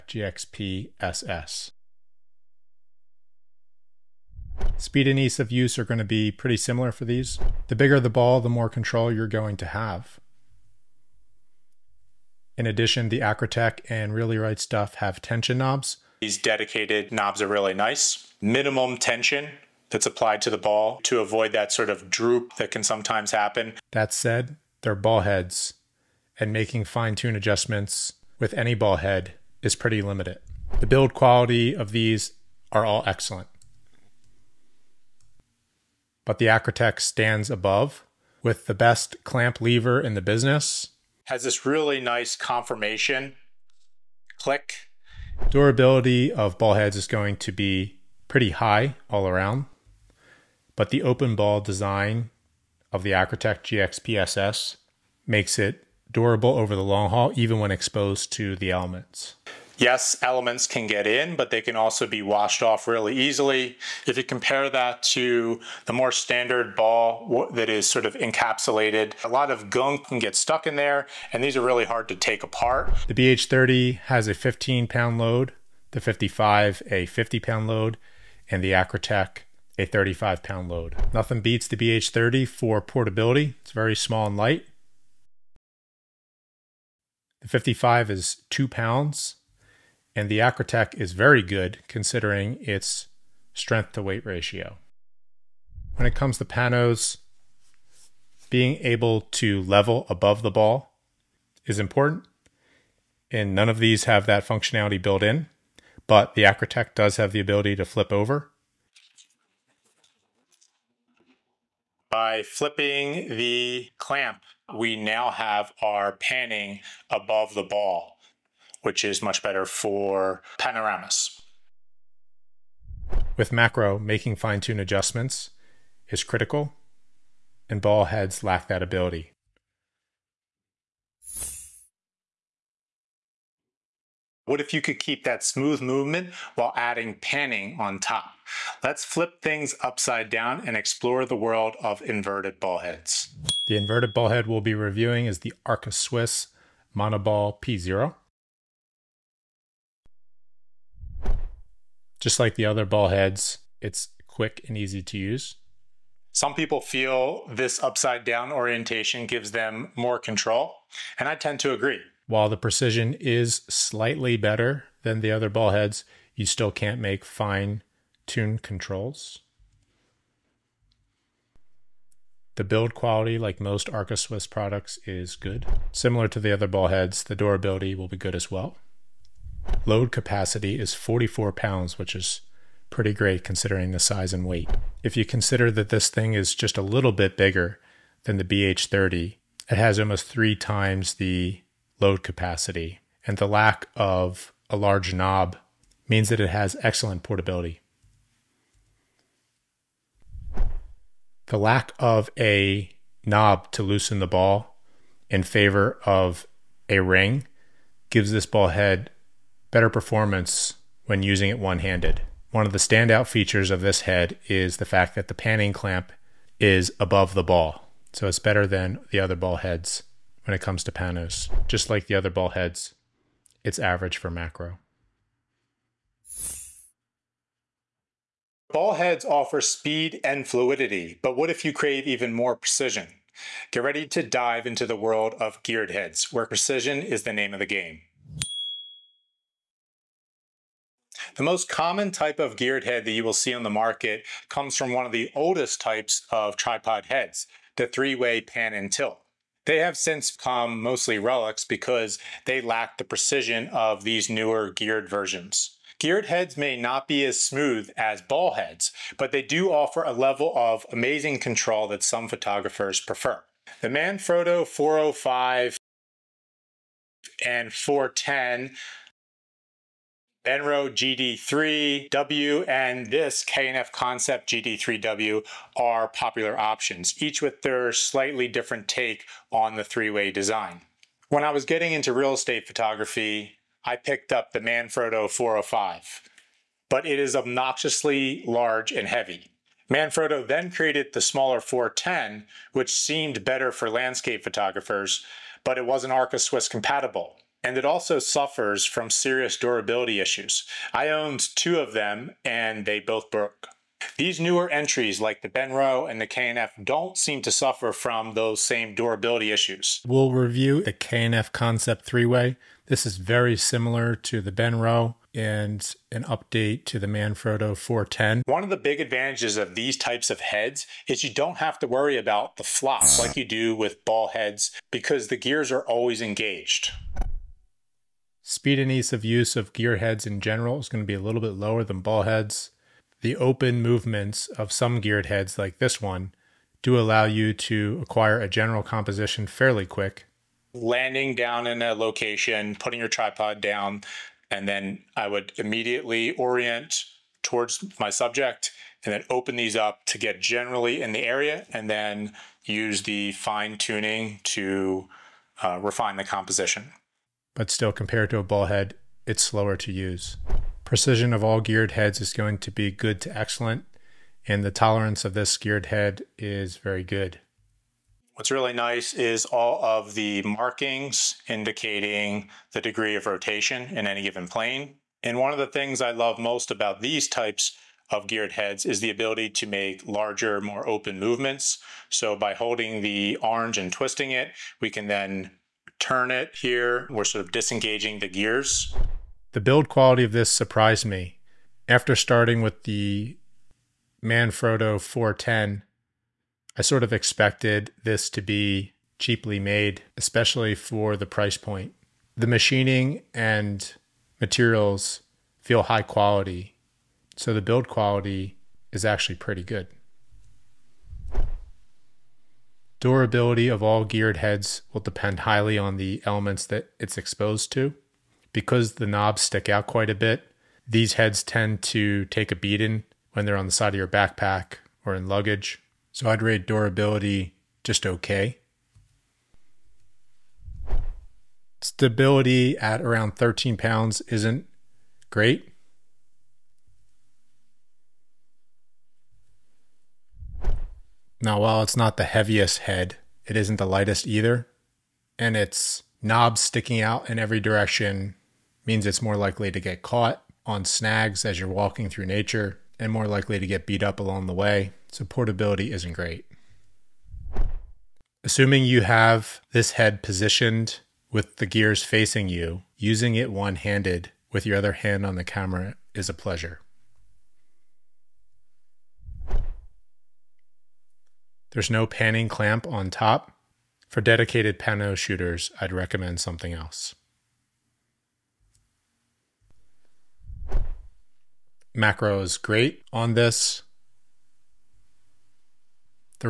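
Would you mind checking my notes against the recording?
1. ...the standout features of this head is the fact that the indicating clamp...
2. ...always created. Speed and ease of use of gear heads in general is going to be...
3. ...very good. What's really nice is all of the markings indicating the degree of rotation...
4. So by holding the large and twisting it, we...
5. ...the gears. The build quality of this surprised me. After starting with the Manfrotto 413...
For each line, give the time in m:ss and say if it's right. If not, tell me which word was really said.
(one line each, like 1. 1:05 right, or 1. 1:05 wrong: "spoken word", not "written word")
1. 3:32 wrong: "panning", not "indicating"
2. 5:25 wrong: "engaged", not "created"
3. 6:06 right
4. 6:22 wrong: "orange", not "large"
5. 6:28 wrong: "410", not "413".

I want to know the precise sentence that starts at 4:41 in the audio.
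When I was getting into real estate photography, I picked up the Manfrotto 405, but it is obnoxiously large and heavy.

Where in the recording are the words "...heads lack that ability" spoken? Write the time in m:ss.
2:08.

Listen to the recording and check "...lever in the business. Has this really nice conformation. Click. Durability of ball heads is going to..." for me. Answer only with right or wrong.
right.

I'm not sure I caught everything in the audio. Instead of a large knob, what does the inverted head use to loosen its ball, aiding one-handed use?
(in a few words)
a ring.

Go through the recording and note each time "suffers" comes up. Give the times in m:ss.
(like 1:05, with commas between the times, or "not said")
4:58, 5:07.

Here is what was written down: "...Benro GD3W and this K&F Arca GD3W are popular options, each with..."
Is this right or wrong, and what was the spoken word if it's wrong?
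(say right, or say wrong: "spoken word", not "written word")
wrong: "Concept", not "Arca".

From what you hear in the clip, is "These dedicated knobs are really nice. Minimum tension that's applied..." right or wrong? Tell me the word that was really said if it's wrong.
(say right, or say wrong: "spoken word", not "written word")
right.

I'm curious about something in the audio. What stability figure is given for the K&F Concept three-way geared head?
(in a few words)
13 pounds.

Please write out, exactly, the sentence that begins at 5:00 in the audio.
I owned two of them and they both broke.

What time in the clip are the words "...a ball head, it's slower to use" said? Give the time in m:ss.
5:58.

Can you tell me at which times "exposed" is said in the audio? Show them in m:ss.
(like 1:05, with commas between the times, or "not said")
0:57, 6:57.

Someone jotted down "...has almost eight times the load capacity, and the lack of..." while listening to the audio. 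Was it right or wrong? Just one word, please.
wrong.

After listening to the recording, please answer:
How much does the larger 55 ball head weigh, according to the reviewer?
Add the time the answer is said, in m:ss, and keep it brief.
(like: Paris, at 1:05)
2 pounds, at 1:28.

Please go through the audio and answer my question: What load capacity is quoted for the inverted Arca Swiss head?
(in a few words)
44 pounds.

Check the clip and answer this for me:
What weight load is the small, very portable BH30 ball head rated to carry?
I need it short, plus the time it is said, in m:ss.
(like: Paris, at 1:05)
15 pounds, at 1:14.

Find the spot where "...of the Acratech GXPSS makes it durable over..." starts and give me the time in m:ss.
0:52.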